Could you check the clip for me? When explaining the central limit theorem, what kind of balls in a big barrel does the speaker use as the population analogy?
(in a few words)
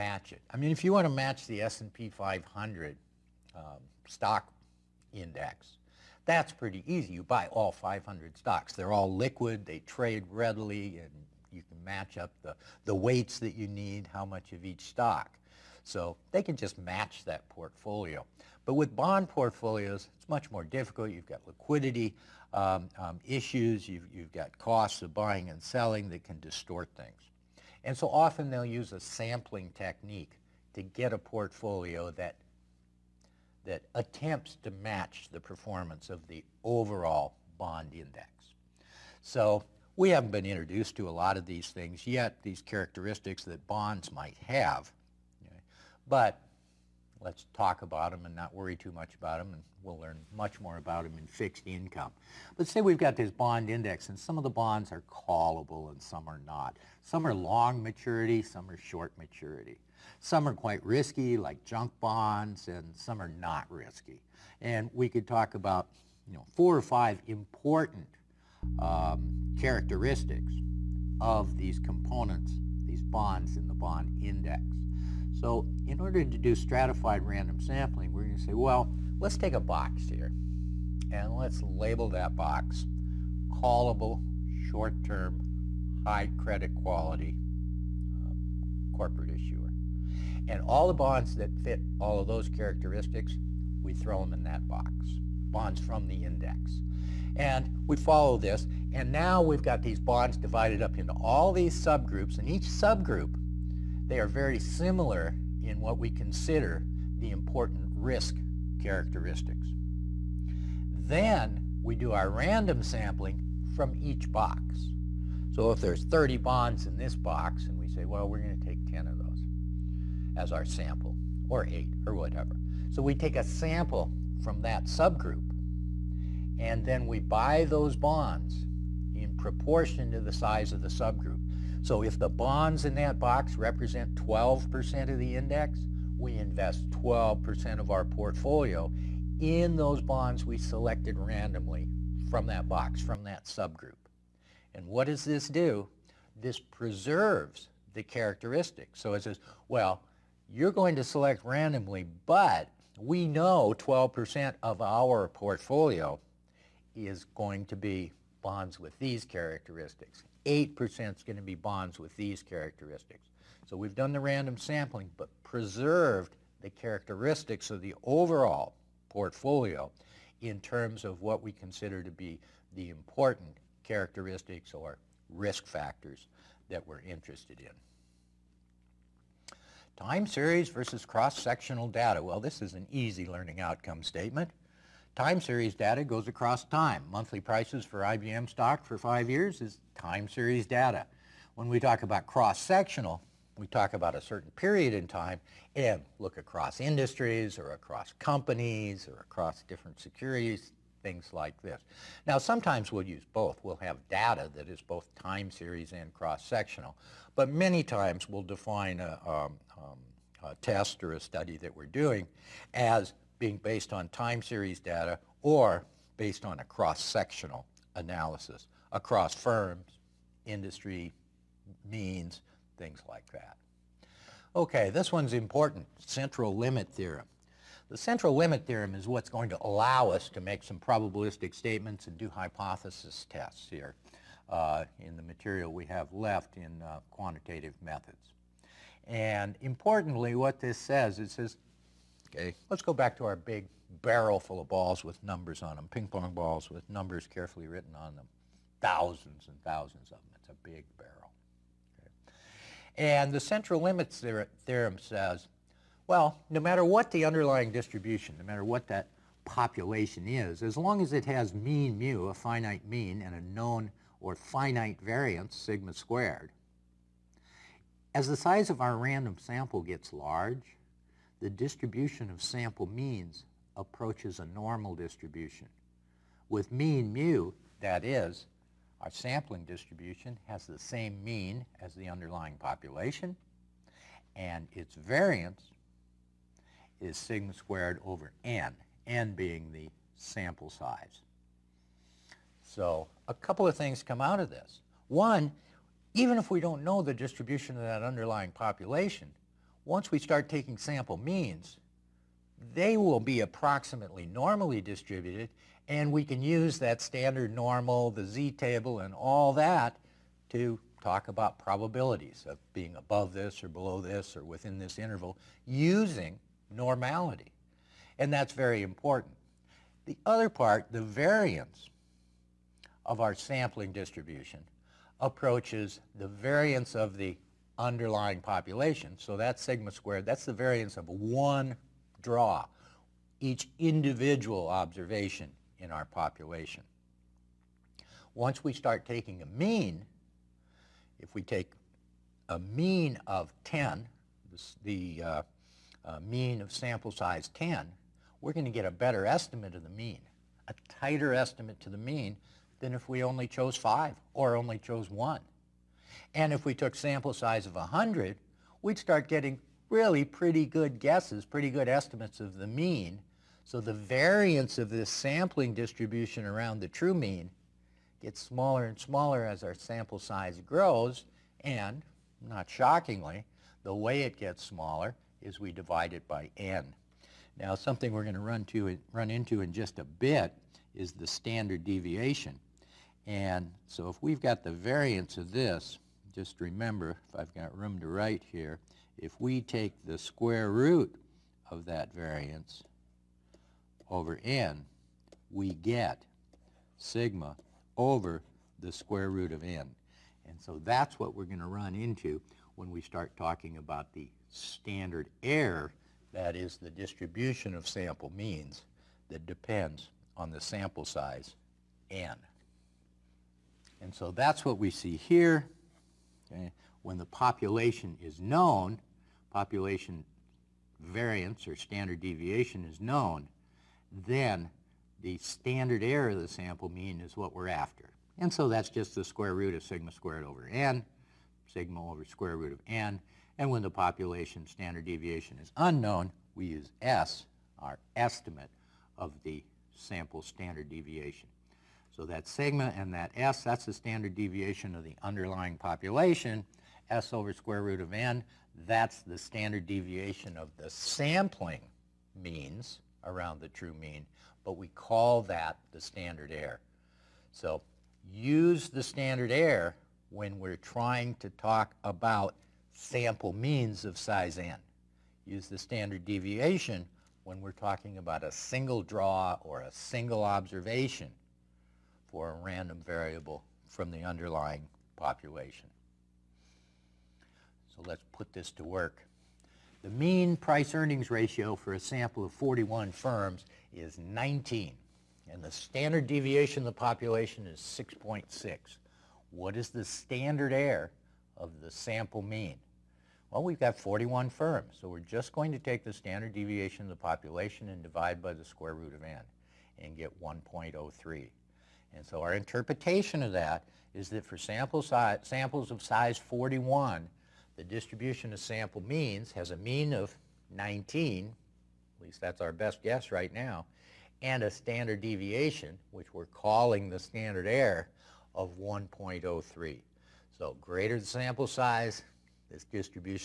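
Ping pong balls.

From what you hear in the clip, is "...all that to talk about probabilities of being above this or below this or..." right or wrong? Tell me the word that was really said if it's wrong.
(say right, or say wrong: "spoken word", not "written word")
right.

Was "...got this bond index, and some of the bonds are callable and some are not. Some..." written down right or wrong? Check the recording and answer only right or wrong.
right.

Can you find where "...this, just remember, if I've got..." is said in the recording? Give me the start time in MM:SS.
06:25.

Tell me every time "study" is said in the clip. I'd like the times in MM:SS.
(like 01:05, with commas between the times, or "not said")
03:31.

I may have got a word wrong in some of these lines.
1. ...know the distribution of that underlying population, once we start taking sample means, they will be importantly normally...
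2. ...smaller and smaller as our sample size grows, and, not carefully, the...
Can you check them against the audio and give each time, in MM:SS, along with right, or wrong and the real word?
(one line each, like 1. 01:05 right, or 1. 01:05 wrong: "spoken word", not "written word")
1. 04:56 wrong: "approximately", not "importantly"
2. 06:08 wrong: "shockingly", not "carefully".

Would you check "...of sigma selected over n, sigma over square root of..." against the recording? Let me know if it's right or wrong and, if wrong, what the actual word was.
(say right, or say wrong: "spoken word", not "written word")
wrong: "squared", not "selected".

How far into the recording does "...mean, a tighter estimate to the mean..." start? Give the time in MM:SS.
05:49.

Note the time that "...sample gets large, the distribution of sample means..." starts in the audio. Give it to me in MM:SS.
04:29.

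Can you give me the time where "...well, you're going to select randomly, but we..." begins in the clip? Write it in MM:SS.
02:29.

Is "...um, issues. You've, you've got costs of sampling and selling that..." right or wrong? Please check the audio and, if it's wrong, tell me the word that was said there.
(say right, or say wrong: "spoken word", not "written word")
wrong: "buying", not "sampling".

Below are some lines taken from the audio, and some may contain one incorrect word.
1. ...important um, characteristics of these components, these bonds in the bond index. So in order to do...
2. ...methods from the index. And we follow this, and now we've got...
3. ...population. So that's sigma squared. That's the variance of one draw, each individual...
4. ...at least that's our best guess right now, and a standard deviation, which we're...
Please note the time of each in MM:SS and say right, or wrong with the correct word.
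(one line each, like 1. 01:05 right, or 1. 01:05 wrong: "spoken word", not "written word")
1. 01:07 right
2. 01:35 wrong: "bonds", not "methods"
3. 05:28 right
4. 08:32 right.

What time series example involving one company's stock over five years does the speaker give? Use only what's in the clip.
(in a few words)
Monthly prices for IBM stock.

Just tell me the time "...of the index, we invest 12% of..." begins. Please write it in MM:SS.
02:15.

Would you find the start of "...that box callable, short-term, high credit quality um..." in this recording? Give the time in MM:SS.
01:22.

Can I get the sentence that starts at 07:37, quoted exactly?
So use the standard error when we're trying to talk about sample means of size n.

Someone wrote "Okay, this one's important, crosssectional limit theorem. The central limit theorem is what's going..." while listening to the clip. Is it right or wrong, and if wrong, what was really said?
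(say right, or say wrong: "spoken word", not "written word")
wrong: "central", not "crosssectional".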